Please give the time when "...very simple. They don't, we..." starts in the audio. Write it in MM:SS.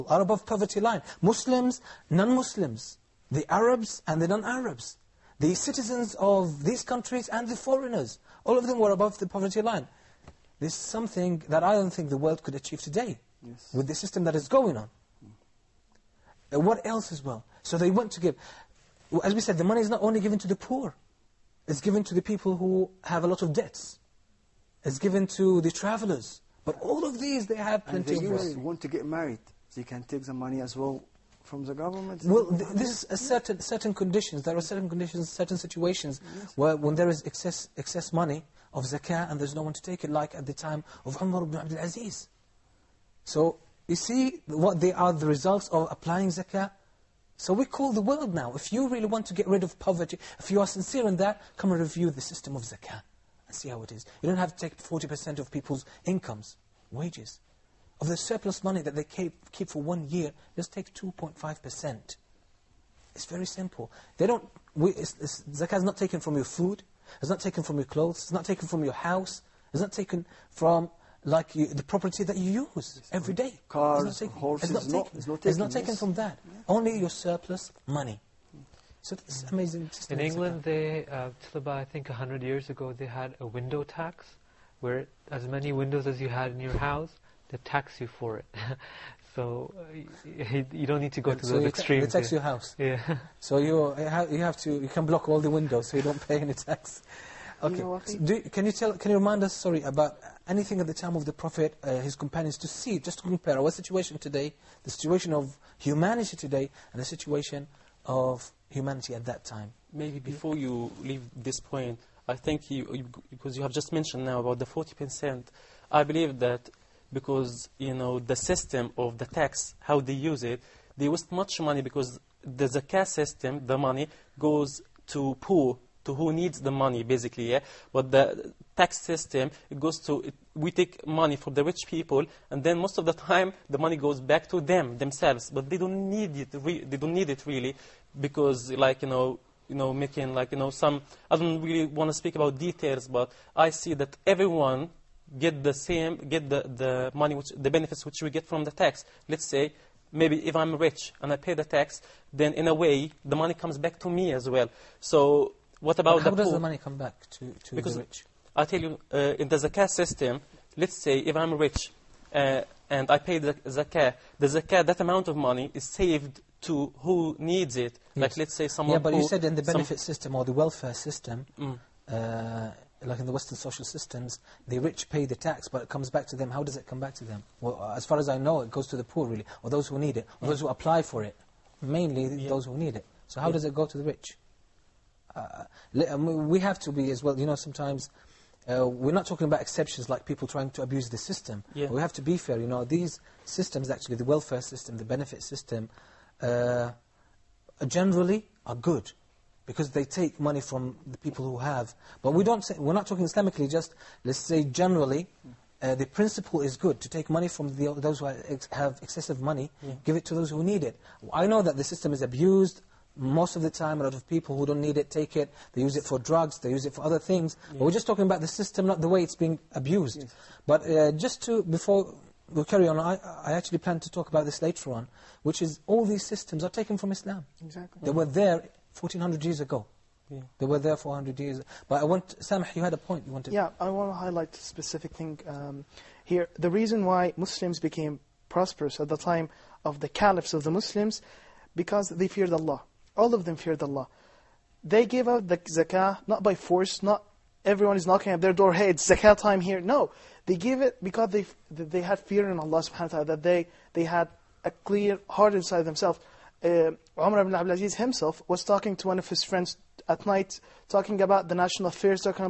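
01:03.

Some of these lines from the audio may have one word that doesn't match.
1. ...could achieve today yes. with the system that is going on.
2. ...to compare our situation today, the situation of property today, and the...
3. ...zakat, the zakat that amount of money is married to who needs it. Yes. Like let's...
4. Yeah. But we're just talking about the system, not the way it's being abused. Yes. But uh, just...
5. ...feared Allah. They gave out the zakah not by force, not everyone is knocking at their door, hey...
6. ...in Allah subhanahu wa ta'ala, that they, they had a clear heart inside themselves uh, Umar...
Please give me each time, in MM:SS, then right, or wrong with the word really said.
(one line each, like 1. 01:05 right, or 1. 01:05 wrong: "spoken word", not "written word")
1. 00:12 right
2. 01:43 wrong: "humanity", not "property"
3. 02:43 wrong: "saved", not "married"
4. 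03:37 right
5. 04:03 right
6. 04:12 right.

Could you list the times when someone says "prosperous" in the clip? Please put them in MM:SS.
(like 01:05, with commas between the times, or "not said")
03:58.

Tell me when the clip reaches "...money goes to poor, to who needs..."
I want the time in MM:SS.
02:03.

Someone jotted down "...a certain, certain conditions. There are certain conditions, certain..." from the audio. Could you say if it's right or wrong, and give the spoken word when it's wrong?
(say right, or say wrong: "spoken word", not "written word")
right.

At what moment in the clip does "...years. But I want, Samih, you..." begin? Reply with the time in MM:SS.
03:51.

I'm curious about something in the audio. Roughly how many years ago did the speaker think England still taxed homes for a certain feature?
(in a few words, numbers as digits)
100.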